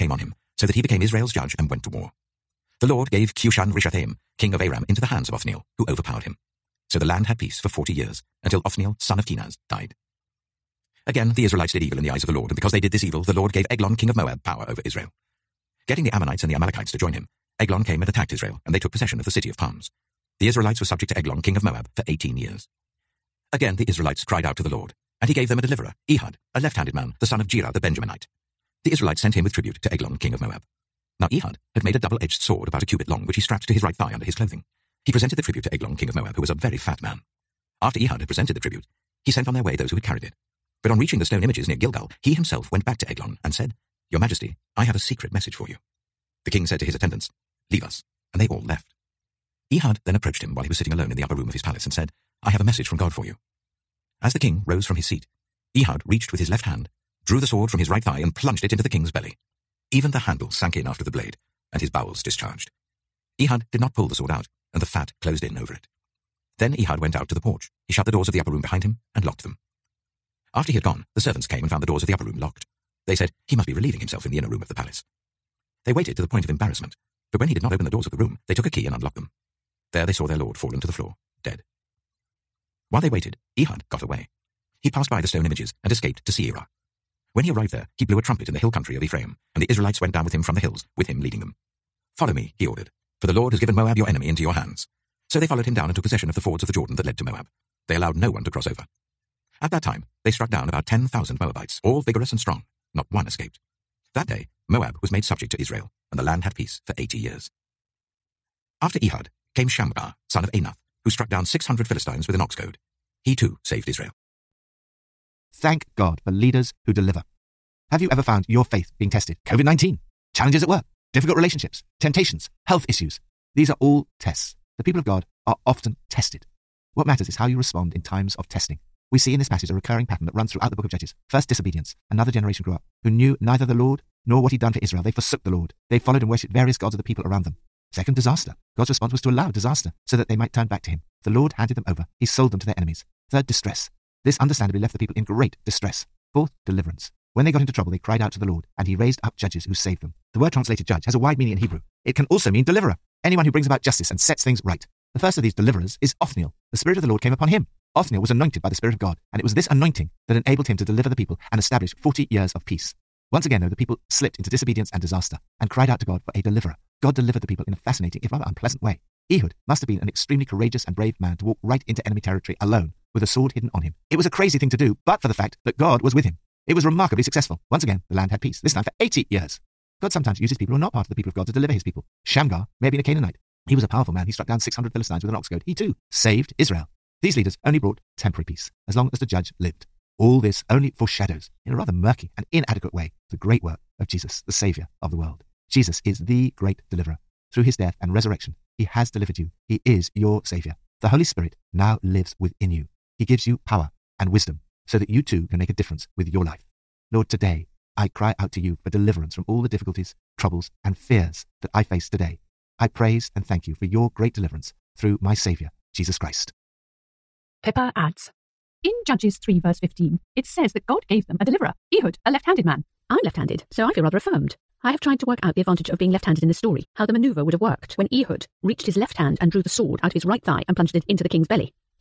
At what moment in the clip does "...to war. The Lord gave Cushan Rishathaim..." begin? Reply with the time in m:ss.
0:01.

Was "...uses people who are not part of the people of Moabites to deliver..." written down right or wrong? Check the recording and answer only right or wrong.
wrong.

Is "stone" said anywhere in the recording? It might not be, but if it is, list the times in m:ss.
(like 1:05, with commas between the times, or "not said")
0:41, 1:25.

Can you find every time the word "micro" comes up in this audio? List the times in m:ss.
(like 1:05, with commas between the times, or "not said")
not said.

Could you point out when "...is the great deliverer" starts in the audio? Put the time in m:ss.
3:16.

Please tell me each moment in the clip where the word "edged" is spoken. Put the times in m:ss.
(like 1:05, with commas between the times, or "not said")
0:31.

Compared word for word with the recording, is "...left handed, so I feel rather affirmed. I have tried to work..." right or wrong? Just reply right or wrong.
right.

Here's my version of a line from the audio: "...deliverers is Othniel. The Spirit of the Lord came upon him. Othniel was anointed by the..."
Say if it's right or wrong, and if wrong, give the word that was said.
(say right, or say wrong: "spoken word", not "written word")
right.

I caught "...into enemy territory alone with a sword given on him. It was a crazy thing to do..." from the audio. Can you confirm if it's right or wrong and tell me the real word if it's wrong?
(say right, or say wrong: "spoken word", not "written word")
wrong: "hidden", not "given".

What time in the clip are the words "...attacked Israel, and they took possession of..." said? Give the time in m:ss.
0:18.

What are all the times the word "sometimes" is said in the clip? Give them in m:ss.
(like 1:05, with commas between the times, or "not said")
3:00.